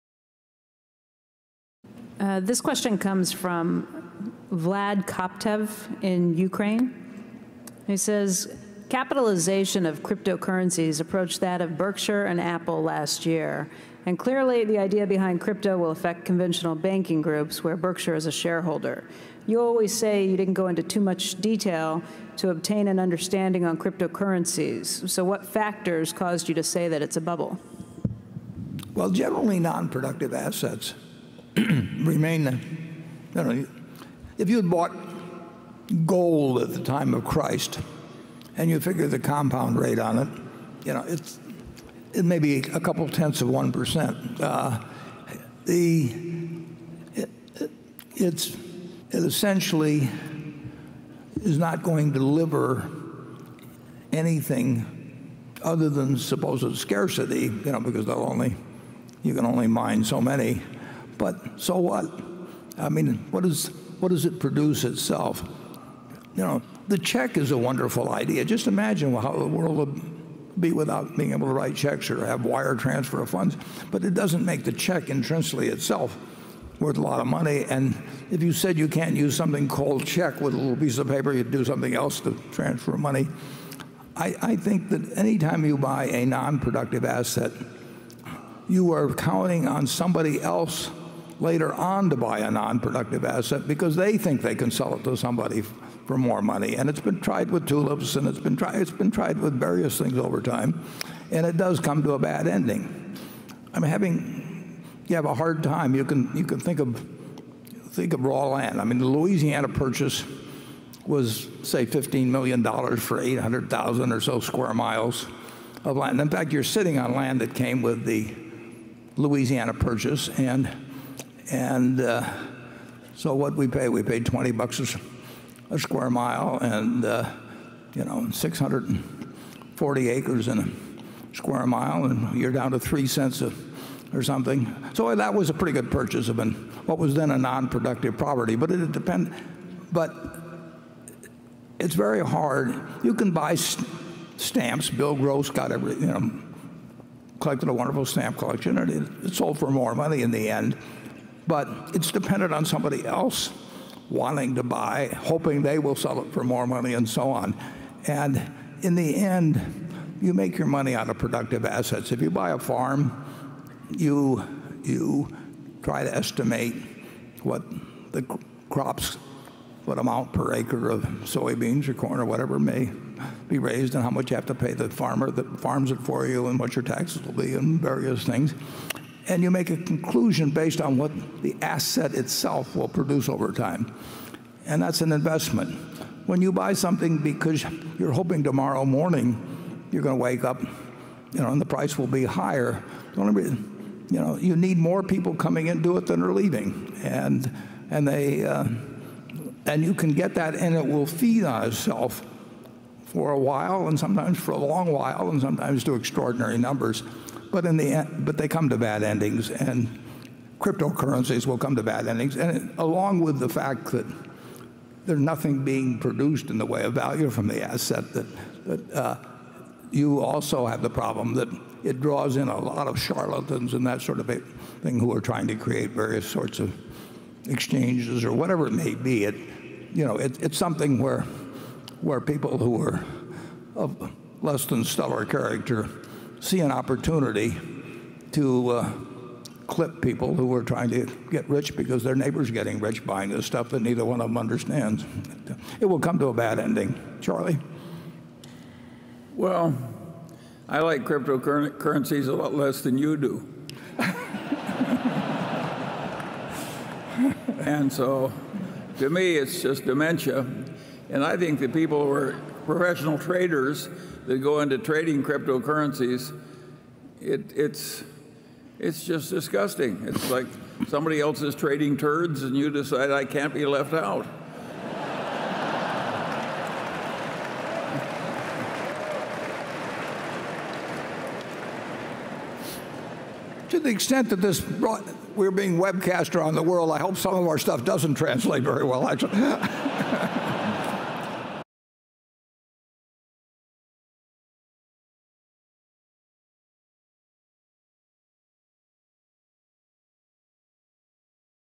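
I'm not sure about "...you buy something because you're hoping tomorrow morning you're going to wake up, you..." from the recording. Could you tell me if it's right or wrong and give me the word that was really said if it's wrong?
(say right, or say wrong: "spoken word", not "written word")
right.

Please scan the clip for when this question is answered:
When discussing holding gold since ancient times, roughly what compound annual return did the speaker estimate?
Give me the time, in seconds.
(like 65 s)
42 s.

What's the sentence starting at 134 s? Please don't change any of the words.
So that was a pretty good purchase of an, what was then a non-productive property.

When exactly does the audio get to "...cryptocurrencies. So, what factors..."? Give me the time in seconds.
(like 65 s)
23 s.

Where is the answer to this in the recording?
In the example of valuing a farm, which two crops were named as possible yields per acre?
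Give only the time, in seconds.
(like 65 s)
171 s.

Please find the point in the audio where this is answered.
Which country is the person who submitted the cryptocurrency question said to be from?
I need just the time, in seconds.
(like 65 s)
6 s.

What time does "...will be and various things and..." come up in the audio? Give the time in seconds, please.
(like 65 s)
177 s.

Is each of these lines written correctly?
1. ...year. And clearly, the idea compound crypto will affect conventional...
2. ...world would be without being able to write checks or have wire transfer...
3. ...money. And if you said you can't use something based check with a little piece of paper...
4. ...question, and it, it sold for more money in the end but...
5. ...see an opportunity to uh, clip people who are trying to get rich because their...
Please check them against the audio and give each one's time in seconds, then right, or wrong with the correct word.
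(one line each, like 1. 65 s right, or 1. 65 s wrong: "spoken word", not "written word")
1. 13 s wrong: "behind", not "compound"
2. 69 s right
3. 77 s wrong: "called", not "based"
4. 148 s wrong: "collection", not "question"
5. 236 s right.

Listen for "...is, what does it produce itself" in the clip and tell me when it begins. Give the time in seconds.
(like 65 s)
63 s.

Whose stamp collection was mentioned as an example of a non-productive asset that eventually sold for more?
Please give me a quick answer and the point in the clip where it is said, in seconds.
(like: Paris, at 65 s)
Bill Gross, at 144 s.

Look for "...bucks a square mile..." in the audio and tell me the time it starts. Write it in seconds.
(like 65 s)
124 s.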